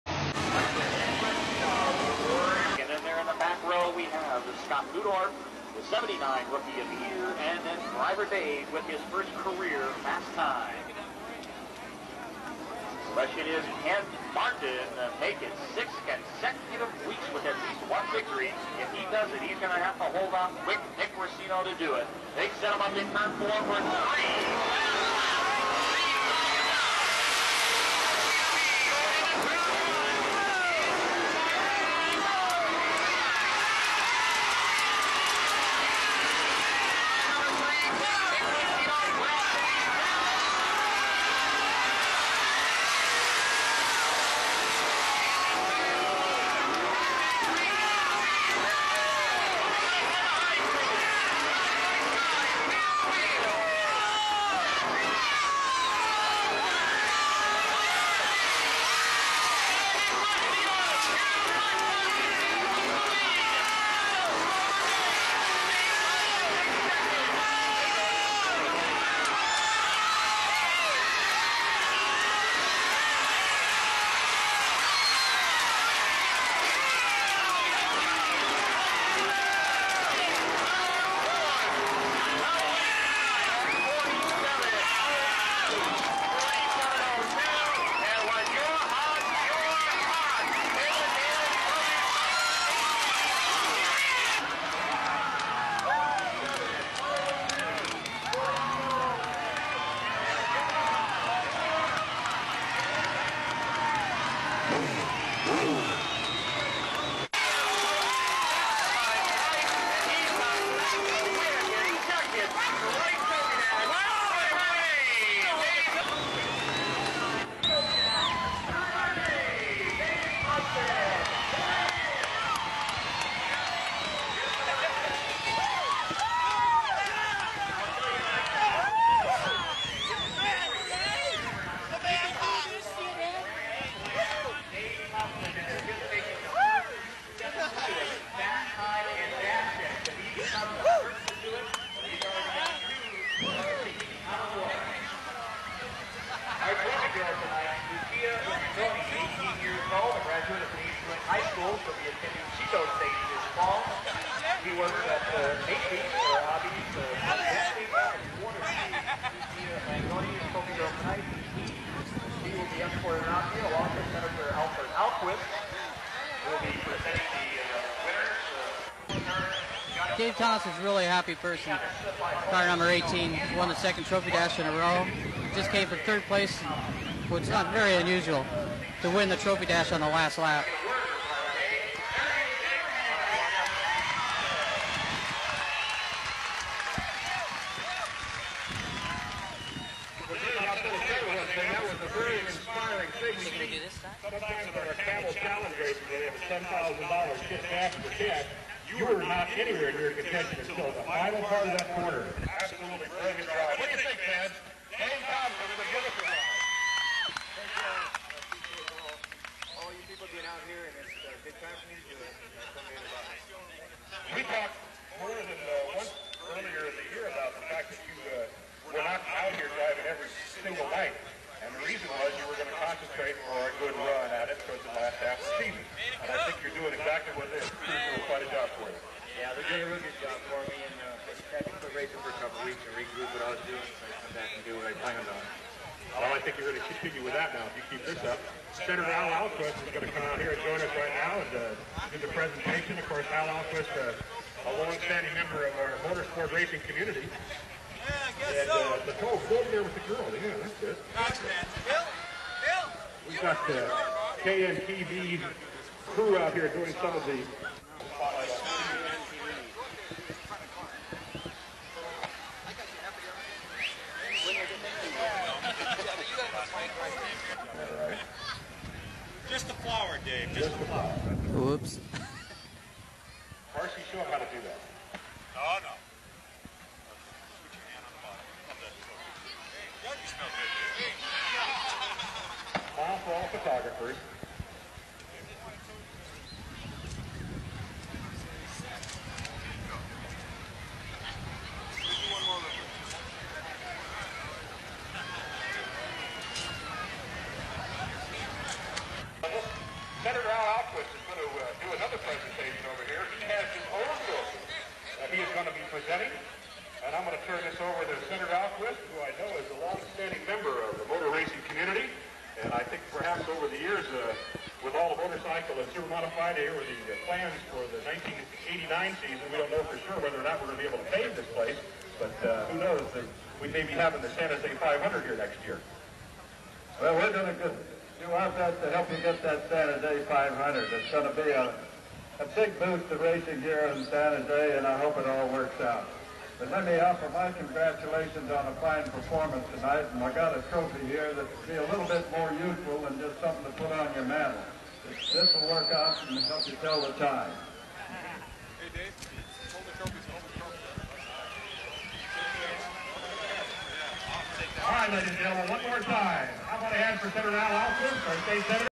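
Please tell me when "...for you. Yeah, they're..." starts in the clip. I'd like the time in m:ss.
3:48.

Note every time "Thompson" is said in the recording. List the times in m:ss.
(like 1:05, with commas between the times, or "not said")
2:50, 3:25.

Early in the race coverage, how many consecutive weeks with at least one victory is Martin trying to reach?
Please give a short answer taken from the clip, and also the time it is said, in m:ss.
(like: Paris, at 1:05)
6, at 0:15.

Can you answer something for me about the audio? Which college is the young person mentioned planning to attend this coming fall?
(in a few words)
Chico State.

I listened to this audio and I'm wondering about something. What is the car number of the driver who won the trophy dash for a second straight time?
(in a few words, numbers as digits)
18.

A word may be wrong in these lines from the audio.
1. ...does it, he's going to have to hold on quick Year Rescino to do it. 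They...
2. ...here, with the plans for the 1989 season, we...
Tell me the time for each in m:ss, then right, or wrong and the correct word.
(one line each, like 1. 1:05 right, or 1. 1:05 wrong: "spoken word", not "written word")
1. 0:19 wrong: "Nick", not "Year"
2. 5:15 right.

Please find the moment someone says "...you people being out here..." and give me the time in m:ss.
3:29.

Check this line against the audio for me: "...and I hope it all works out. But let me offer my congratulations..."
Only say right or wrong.
right.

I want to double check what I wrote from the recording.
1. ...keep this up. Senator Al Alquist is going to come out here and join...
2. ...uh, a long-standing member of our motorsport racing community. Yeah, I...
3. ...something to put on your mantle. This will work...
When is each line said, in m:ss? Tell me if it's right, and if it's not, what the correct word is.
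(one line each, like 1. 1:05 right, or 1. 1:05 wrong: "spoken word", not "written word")
1. 3:57 right
2. 4:04 right
3. 5:43 right.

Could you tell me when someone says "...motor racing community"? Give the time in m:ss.
5:11.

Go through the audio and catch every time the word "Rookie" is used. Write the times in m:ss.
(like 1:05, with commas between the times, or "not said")
0:06.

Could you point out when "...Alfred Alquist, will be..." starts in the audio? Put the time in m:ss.
2:44.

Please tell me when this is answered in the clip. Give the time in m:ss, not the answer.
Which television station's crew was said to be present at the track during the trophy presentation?
4:14.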